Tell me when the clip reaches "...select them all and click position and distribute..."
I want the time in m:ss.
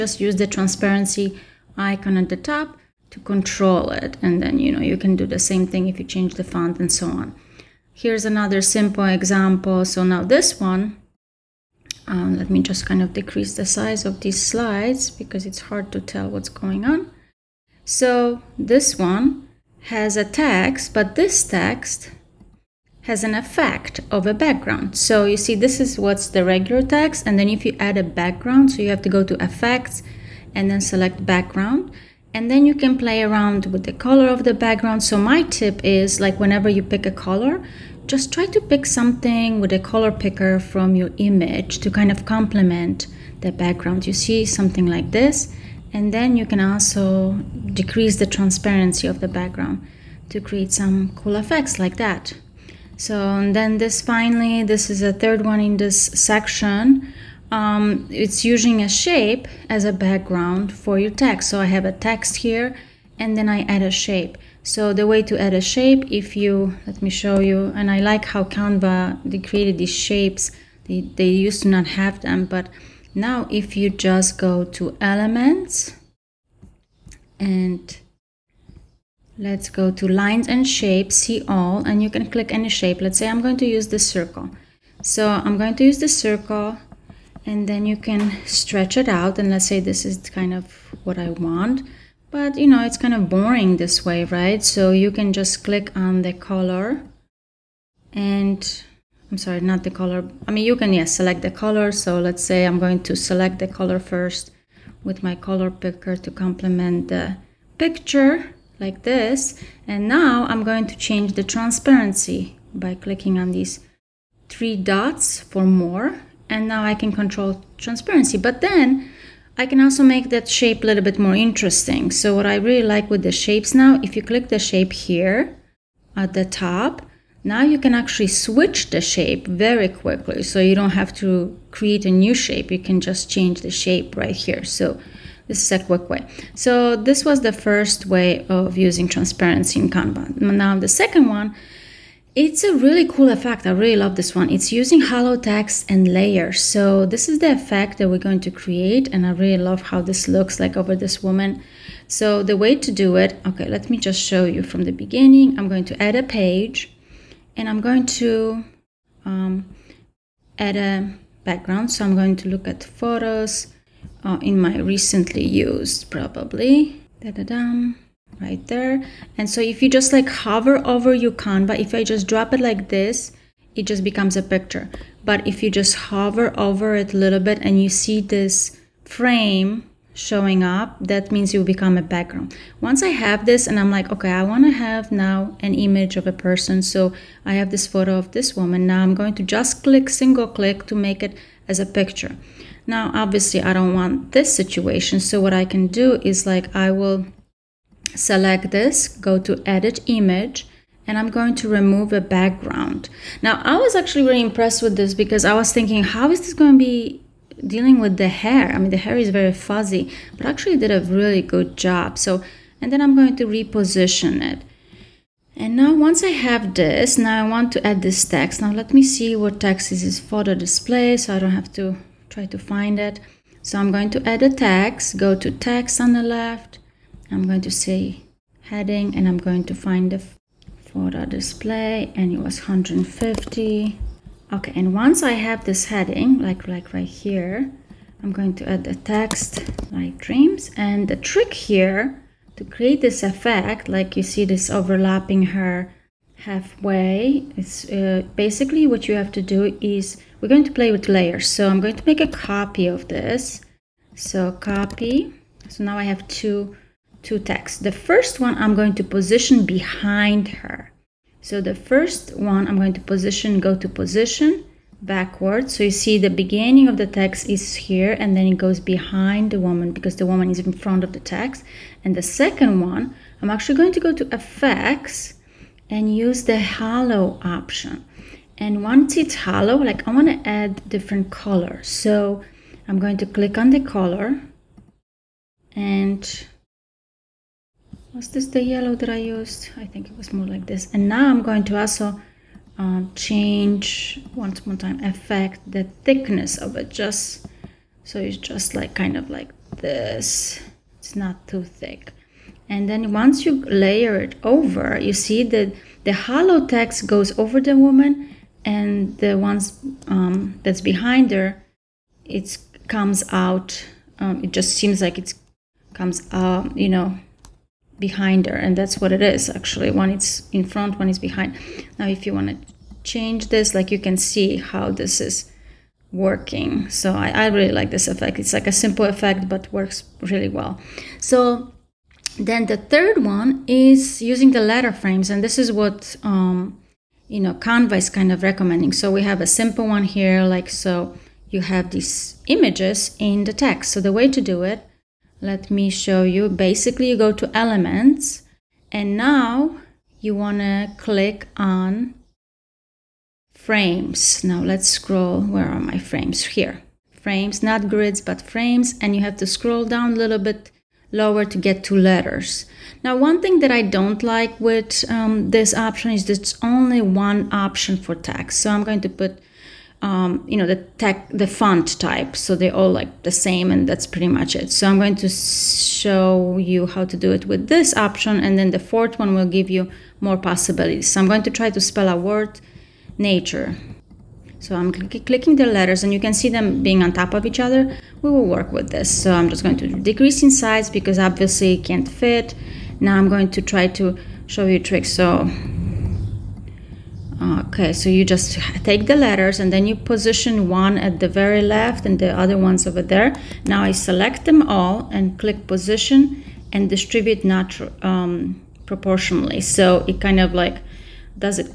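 6:44.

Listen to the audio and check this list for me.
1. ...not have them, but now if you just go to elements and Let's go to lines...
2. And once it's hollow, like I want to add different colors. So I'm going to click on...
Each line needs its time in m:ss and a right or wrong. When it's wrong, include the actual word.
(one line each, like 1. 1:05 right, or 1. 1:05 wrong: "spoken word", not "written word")
1. 1:11 right
2. 4:38 right.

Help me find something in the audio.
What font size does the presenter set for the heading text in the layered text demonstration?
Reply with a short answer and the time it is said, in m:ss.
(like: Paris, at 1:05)
150, at 3:52.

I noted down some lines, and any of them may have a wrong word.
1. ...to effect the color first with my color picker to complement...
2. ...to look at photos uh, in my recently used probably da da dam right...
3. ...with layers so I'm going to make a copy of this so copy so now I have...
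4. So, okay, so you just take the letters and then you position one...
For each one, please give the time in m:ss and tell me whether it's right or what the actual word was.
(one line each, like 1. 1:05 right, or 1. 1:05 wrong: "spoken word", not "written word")
1. 1:43 wrong: "select", not "effect"
2. 2:42 right
3. 4:10 right
4. 6:35 right.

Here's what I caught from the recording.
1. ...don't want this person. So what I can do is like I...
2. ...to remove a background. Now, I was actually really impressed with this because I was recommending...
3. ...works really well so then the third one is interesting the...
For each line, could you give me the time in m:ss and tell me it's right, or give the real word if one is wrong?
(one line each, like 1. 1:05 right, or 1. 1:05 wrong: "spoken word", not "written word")
1. 3:13 wrong: "situation", not "person"
2. 3:21 wrong: "thinking", not "recommending"
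3. 5:29 wrong: "using", not "interesting".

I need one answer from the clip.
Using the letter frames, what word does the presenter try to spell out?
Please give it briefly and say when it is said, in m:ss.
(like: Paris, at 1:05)
Nature, at 6:23.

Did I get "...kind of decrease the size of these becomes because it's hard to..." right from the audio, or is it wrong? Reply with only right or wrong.
wrong.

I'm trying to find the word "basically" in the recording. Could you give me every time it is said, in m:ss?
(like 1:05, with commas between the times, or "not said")
4:08, 5:46.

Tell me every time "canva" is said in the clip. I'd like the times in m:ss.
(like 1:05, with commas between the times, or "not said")
1:08, 2:19, 2:51, 5:37.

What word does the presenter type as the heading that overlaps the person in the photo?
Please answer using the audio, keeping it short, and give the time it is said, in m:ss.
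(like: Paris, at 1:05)
Dreams, at 4:00.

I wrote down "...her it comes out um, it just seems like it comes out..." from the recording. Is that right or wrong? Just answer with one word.
right.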